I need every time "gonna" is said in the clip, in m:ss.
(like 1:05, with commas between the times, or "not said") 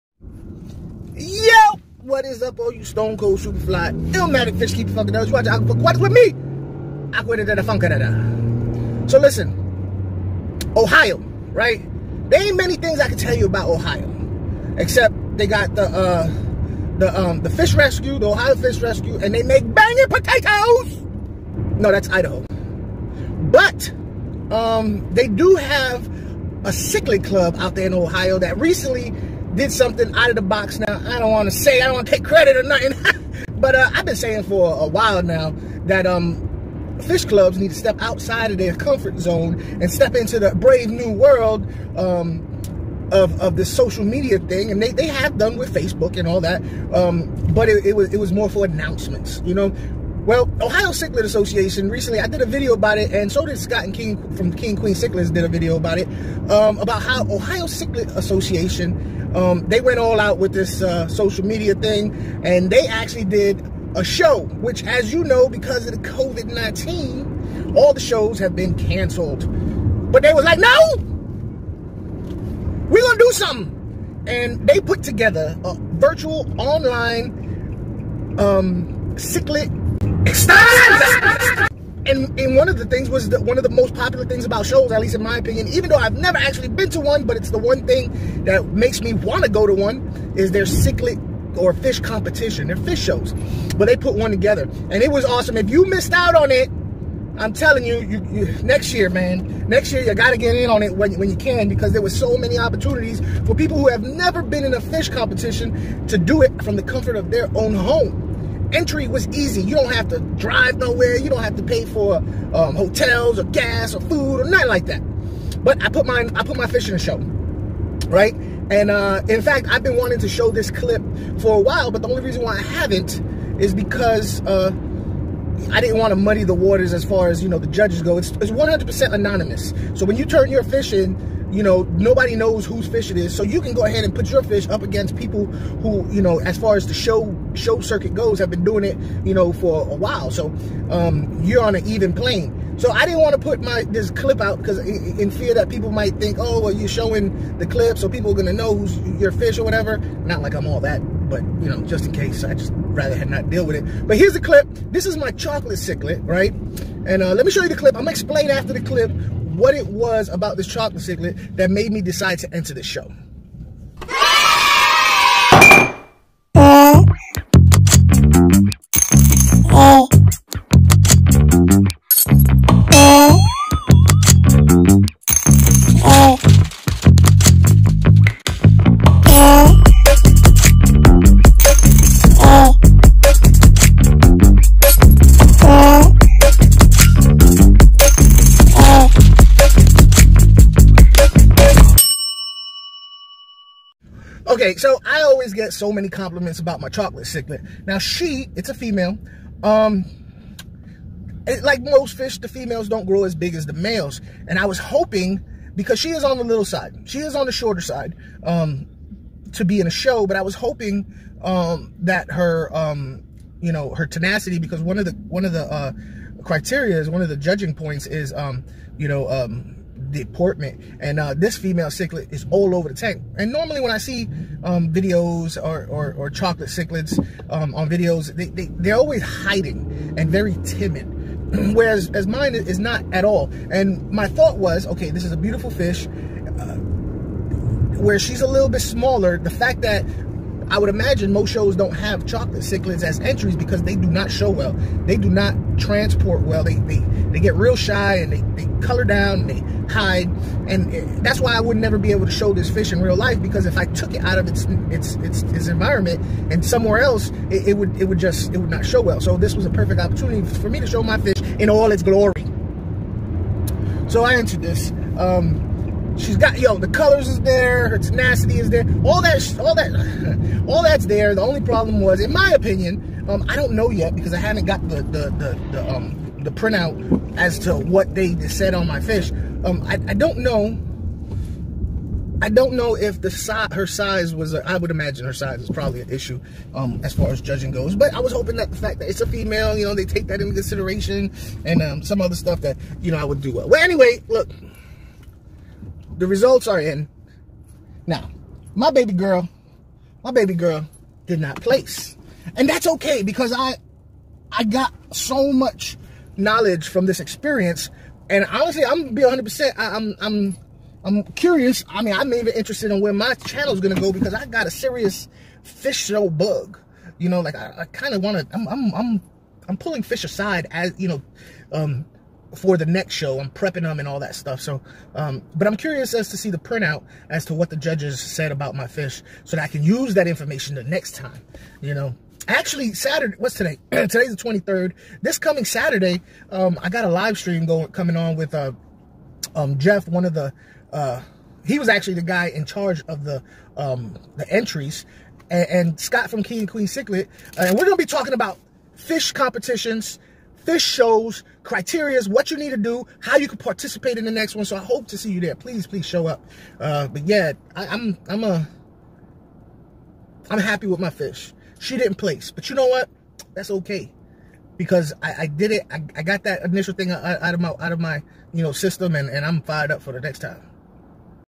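2:28, 2:38, 5:09, 5:13.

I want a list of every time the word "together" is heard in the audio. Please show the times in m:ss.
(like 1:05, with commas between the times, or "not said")
1:15, 1:34.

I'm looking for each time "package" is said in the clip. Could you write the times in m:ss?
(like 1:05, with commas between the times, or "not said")
not said.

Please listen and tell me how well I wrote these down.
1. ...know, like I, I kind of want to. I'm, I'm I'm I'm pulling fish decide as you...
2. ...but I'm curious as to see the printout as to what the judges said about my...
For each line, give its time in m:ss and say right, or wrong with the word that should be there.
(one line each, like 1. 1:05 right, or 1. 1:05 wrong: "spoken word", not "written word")
1. 5:17 wrong: "aside", not "decide"
2. 5:25 right.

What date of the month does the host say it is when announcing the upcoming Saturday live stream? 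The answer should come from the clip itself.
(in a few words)
23rd.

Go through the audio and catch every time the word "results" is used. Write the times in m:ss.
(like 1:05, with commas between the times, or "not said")
4:56.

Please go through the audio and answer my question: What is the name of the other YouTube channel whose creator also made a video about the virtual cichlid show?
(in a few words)
King Queen Cichlids.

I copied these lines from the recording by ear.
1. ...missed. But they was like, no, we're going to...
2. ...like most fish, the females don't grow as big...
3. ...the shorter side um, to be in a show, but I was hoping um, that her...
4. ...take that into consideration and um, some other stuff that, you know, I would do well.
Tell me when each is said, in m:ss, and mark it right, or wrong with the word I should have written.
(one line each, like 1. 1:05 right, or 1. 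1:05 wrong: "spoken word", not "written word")
1. 1:08 wrong: "canceled", not "missed"
2. 3:21 right
3. 3:27 right
4. 4:50 right.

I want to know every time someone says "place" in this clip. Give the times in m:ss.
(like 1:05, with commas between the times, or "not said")
5:01, 6:02.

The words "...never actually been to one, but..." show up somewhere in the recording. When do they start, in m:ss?
1:26.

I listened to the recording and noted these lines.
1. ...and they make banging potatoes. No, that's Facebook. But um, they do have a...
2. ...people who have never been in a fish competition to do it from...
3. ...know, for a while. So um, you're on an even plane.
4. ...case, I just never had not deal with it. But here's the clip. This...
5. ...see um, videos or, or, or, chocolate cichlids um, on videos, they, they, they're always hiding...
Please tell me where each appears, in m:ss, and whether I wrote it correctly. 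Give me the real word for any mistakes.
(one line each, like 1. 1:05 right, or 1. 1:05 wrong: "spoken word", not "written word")
1. 0:19 wrong: "Idaho", not "Facebook"
2. 1:43 right
3. 2:19 right
4. 2:32 wrong: "rather", not "never"
5. 3:43 right.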